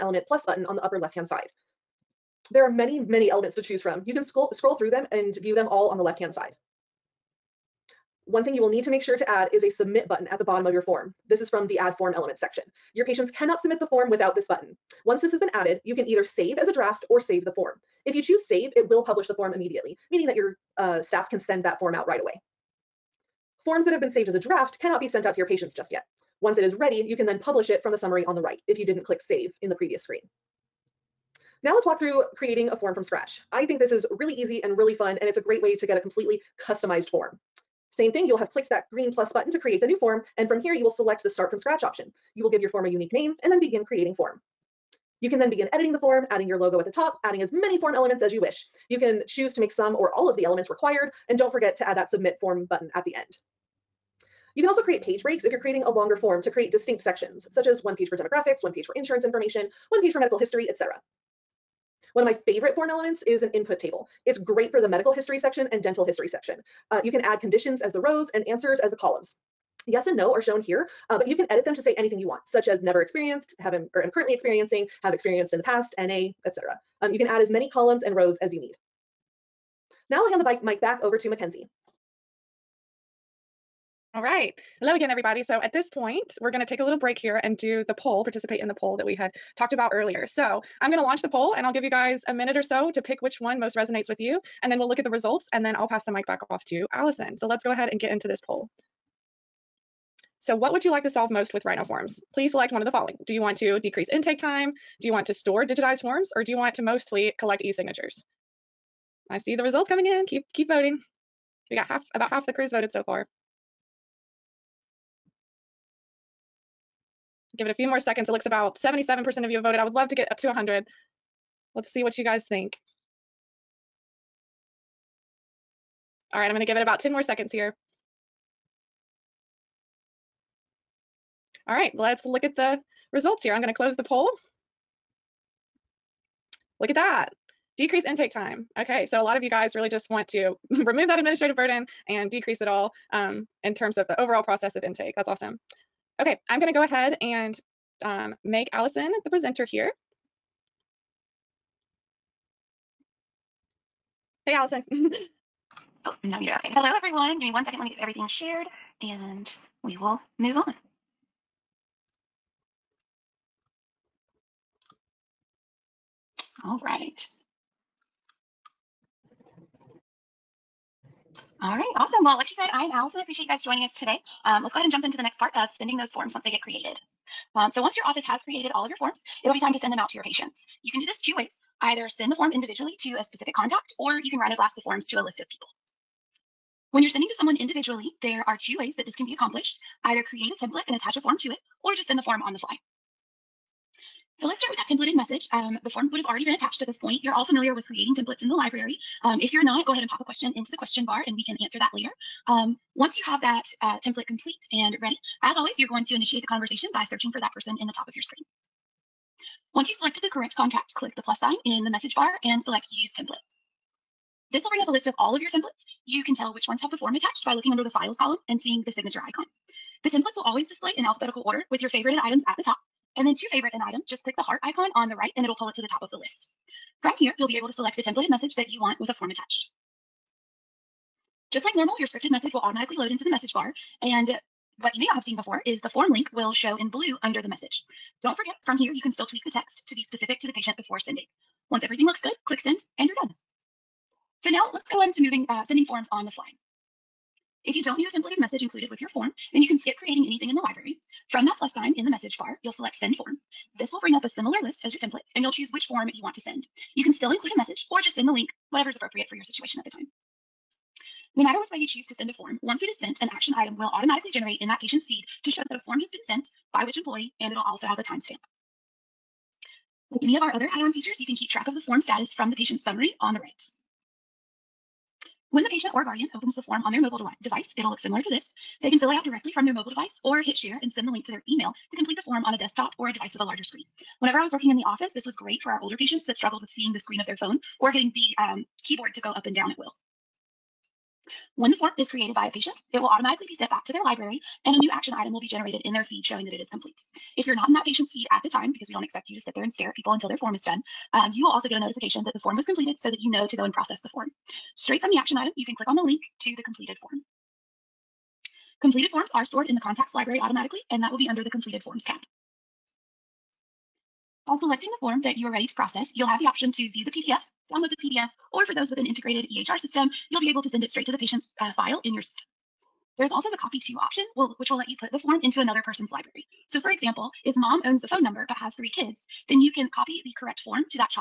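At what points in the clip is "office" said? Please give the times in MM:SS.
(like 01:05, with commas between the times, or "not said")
02:58, 04:44.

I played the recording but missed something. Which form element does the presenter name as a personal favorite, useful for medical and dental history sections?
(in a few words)
Input table.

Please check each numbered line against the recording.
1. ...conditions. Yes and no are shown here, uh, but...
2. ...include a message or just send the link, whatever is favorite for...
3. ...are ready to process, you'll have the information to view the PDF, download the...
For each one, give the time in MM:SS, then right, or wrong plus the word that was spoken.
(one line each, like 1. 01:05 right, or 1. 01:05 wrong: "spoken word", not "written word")
1. 01:08 wrong: "columns", not "conditions"
2. 04:17 wrong: "appropriate", not "favorite"
3. 05:15 wrong: "option", not "information".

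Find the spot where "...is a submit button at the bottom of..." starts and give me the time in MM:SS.
00:09.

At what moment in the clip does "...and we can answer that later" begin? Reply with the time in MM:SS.
03:21.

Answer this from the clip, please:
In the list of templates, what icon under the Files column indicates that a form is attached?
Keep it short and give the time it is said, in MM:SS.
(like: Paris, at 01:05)
Signature icon, at 03:38.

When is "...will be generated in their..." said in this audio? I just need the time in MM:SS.
04:55.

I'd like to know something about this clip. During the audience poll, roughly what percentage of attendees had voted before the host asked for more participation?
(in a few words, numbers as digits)
77%.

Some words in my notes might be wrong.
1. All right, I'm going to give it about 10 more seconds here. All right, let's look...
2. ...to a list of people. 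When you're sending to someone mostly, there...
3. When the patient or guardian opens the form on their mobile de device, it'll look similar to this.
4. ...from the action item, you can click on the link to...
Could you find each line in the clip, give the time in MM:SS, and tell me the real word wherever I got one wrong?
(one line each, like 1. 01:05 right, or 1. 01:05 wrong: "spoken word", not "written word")
1. 02:06 right
2. 03:05 wrong: "individually", not "mostly"
3. 04:35 right
4. 05:05 right.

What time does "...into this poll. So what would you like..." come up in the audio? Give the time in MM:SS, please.
01:38.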